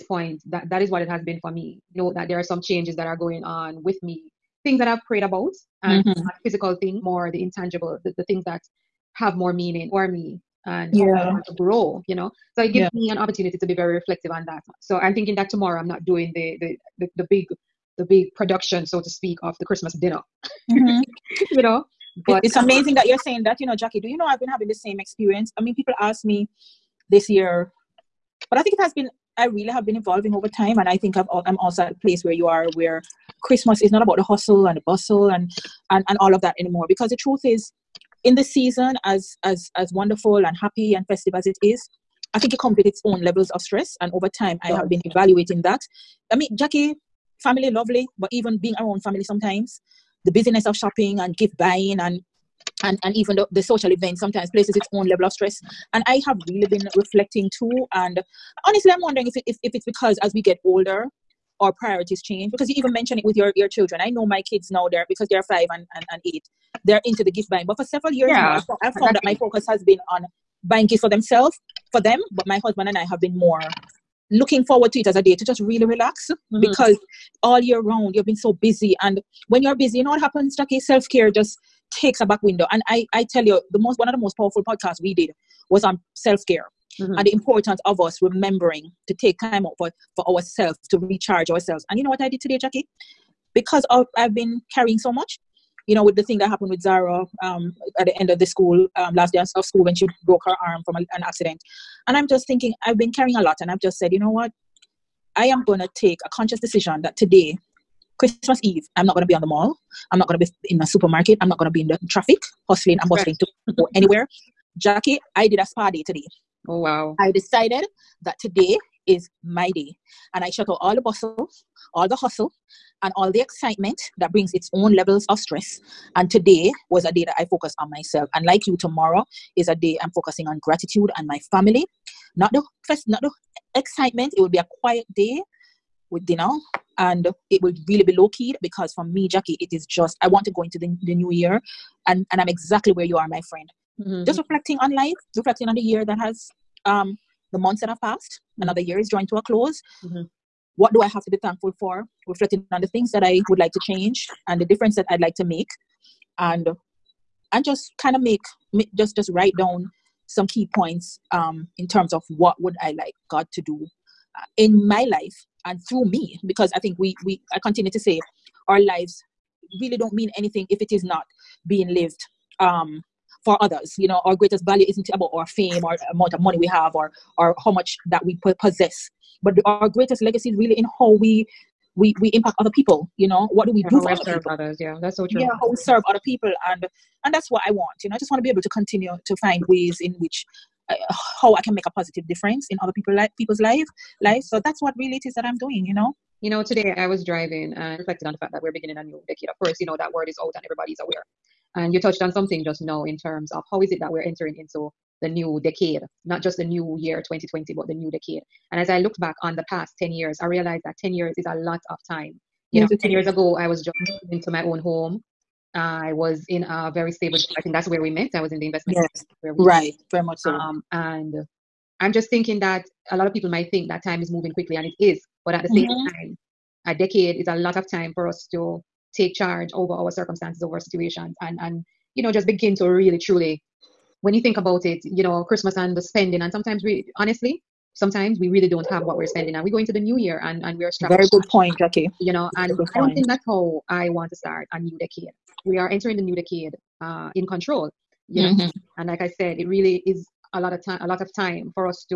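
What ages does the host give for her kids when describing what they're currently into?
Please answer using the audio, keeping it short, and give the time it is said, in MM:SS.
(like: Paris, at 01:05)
5 and 8, at 01:05.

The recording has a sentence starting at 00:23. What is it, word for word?
Do you know I've been having the same experience?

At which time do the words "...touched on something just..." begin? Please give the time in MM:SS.
03:22.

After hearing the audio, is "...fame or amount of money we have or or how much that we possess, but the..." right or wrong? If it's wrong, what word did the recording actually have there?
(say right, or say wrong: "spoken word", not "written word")
right.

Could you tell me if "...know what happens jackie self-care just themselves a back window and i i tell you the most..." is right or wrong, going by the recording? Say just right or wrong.
wrong.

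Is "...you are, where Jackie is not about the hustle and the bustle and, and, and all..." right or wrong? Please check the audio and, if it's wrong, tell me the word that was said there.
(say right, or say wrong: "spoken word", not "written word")
wrong: "Christmas", not "Jackie".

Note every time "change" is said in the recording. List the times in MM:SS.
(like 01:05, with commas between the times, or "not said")
00:02, 01:02, 02:33.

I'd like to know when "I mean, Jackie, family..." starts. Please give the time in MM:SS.
00:46.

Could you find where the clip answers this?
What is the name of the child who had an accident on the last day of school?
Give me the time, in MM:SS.
01:36.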